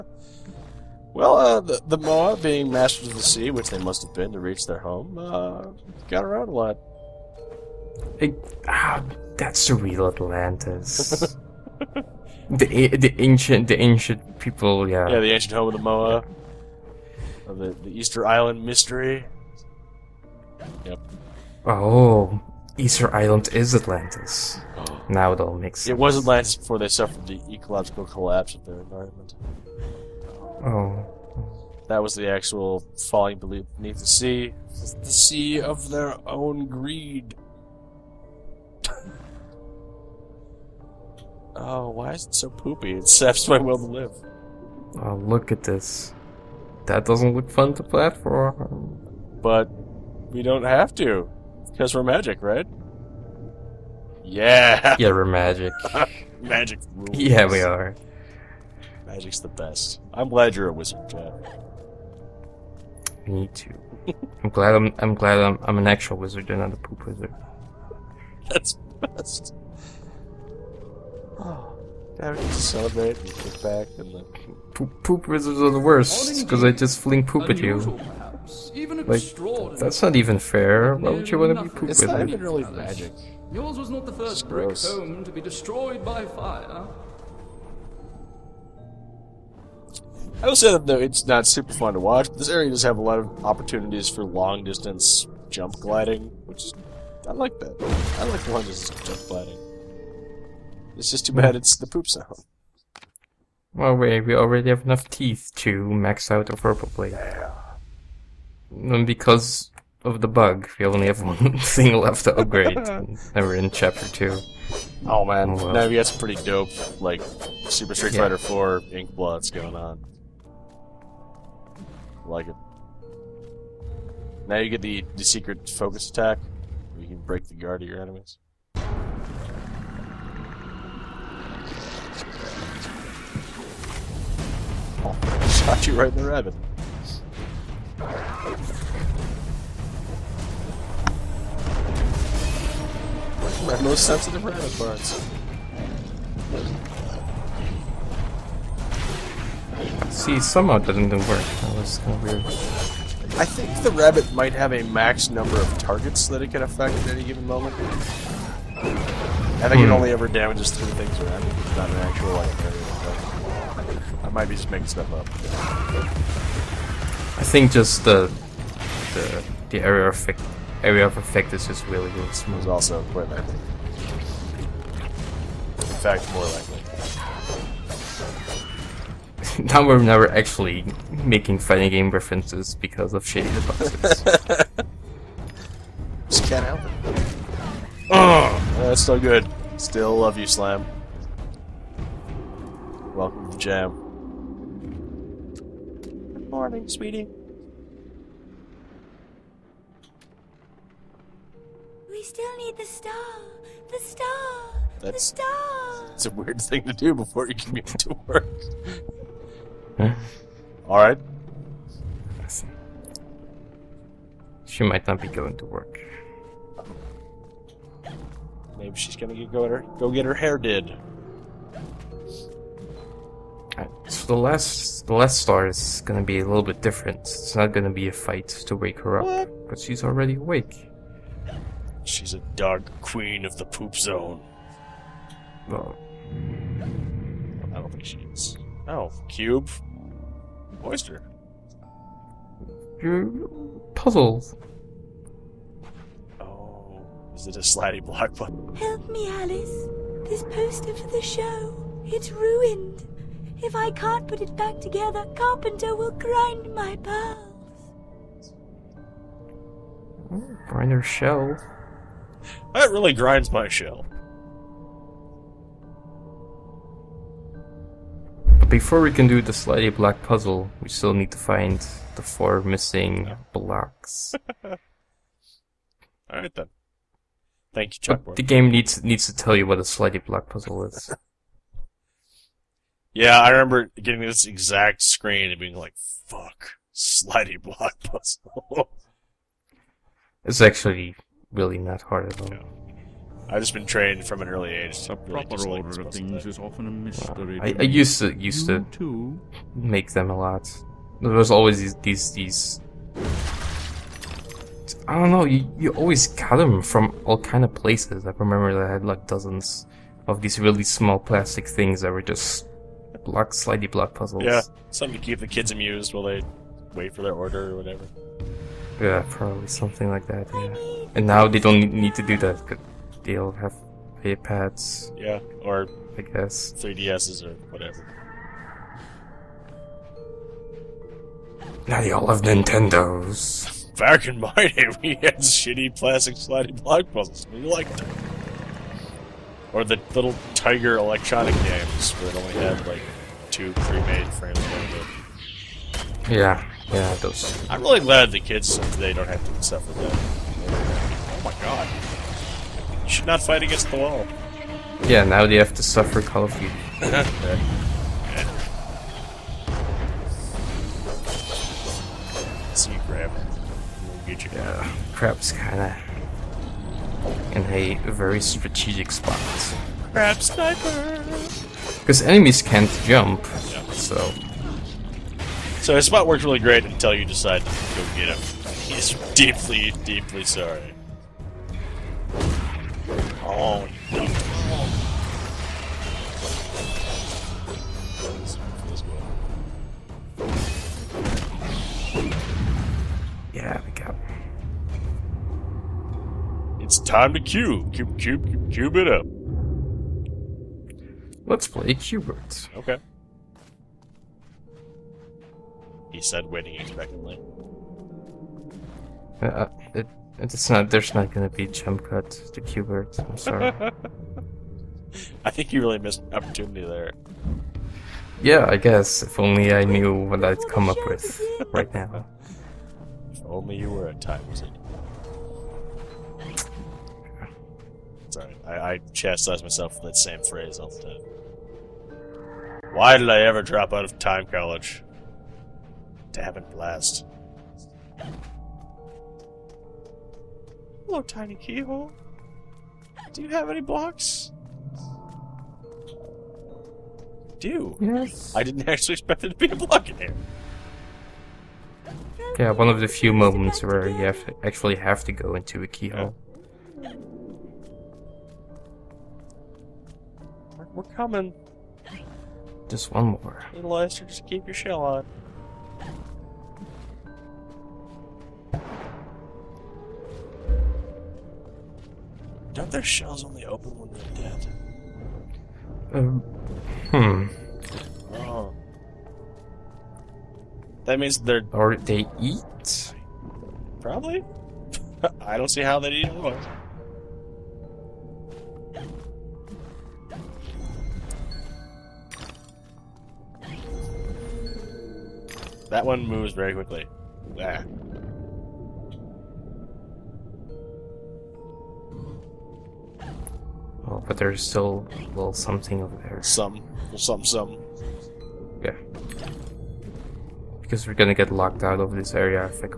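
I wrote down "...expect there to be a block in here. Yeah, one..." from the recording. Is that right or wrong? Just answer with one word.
right.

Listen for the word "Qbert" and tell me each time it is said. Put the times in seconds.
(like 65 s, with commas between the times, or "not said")
401 s, 412 s.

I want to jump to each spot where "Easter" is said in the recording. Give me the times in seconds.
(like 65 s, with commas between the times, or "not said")
17 s, 22 s.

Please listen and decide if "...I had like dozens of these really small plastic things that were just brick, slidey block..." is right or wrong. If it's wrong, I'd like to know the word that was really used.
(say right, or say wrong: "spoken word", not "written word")
wrong: "block", not "brick".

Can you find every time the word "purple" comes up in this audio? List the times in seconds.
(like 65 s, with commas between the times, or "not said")
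106 s.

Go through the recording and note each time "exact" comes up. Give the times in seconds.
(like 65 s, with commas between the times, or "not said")
284 s.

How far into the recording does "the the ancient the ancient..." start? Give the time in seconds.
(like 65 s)
12 s.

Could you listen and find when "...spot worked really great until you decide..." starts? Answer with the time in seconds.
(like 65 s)
376 s.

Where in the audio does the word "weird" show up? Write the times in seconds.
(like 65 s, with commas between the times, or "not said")
152 s, 206 s.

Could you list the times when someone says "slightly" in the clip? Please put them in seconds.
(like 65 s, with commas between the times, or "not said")
269 s, 279 s.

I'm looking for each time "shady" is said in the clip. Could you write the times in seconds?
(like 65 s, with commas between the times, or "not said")
183 s.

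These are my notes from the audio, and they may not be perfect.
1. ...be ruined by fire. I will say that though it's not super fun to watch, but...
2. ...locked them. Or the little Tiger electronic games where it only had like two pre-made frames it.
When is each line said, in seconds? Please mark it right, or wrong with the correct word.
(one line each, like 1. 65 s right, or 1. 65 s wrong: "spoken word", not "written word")
1. 85 s wrong: "destroyed", not "ruined"
2. 337 s wrong: "liked", not "locked".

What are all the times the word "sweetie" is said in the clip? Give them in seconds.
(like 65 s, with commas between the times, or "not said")
196 s.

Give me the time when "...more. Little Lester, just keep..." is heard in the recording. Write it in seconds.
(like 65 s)
463 s.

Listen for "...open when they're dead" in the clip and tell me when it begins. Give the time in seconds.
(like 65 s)
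473 s.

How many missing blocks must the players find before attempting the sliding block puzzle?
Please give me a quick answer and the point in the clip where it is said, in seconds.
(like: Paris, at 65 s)
4, at 272 s.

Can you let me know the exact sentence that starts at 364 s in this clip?
Yeah, crap's kinda in a very strategic spot.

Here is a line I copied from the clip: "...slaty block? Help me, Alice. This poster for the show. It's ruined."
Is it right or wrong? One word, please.
right.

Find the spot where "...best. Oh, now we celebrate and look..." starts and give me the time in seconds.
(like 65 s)
69 s.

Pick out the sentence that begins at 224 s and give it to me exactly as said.
So the last, the last star is gonna be a little bit different.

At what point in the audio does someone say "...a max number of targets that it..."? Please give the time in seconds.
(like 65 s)
154 s.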